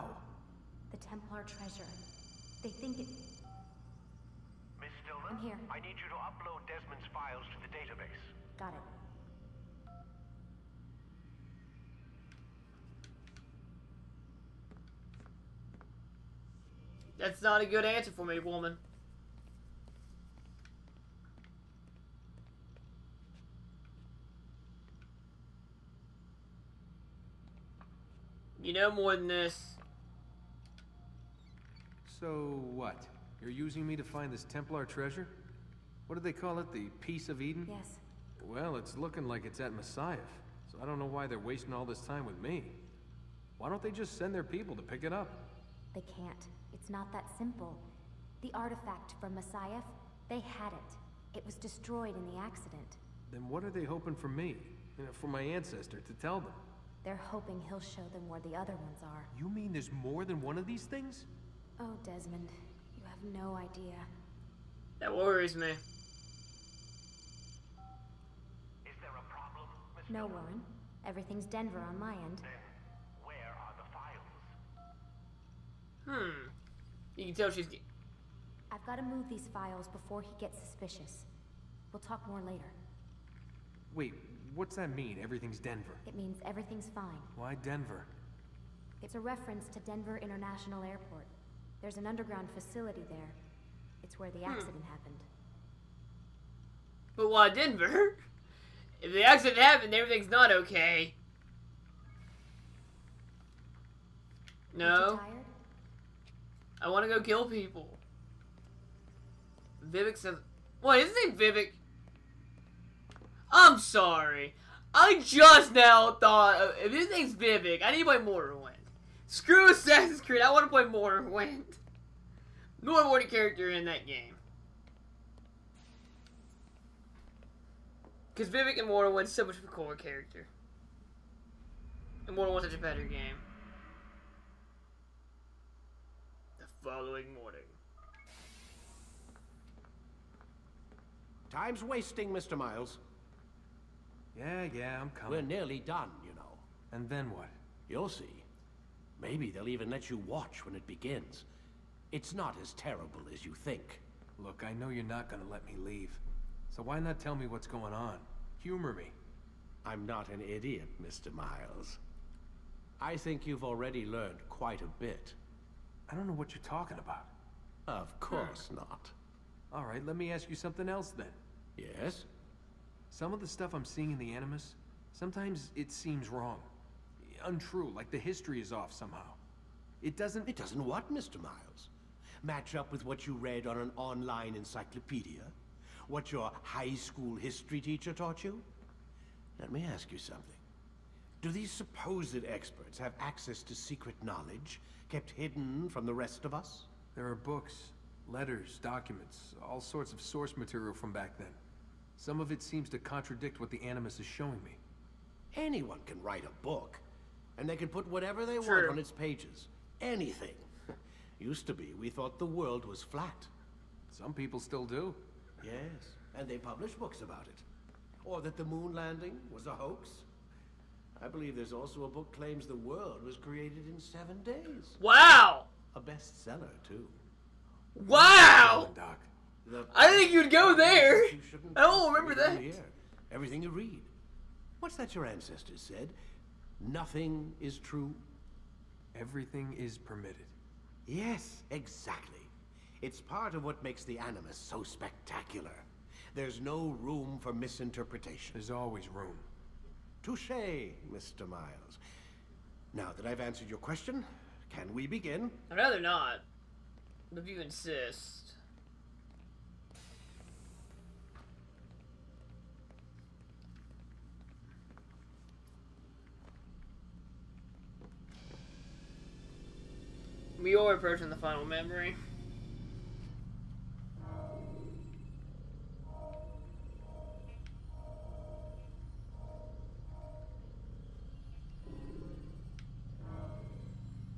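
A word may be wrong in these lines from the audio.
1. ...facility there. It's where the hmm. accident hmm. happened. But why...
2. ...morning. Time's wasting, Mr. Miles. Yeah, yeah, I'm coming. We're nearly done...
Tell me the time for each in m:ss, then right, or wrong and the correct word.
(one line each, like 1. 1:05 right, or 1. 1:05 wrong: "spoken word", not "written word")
1. 1:32 right
2. 2:17 right.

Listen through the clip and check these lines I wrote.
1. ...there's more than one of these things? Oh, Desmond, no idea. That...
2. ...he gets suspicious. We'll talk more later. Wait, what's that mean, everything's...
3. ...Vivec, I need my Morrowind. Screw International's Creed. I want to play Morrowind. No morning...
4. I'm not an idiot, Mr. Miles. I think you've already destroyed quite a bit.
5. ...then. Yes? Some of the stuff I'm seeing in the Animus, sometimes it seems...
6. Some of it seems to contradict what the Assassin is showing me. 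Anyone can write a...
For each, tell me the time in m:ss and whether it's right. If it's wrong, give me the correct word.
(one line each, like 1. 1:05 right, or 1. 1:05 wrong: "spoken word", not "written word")
1. 0:59 right
2. 1:20 right
3. 1:57 wrong: "Assassin", not "International"
4. 2:39 wrong: "learned", not "destroyed"
5. 2:51 right
6. 3:22 wrong: "Animus", not "Assassin".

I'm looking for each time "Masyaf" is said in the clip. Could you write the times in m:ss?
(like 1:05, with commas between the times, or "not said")
0:39, 0:49.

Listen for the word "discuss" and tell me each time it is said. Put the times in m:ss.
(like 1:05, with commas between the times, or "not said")
not said.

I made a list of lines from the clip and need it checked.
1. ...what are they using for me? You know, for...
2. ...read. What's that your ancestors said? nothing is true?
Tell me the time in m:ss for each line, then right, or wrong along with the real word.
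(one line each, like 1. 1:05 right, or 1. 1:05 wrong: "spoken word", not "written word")
1. 0:53 wrong: "hoping", not "using"
2. 3:53 right.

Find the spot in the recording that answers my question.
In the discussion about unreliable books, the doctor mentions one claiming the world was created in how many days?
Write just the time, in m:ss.
3:43.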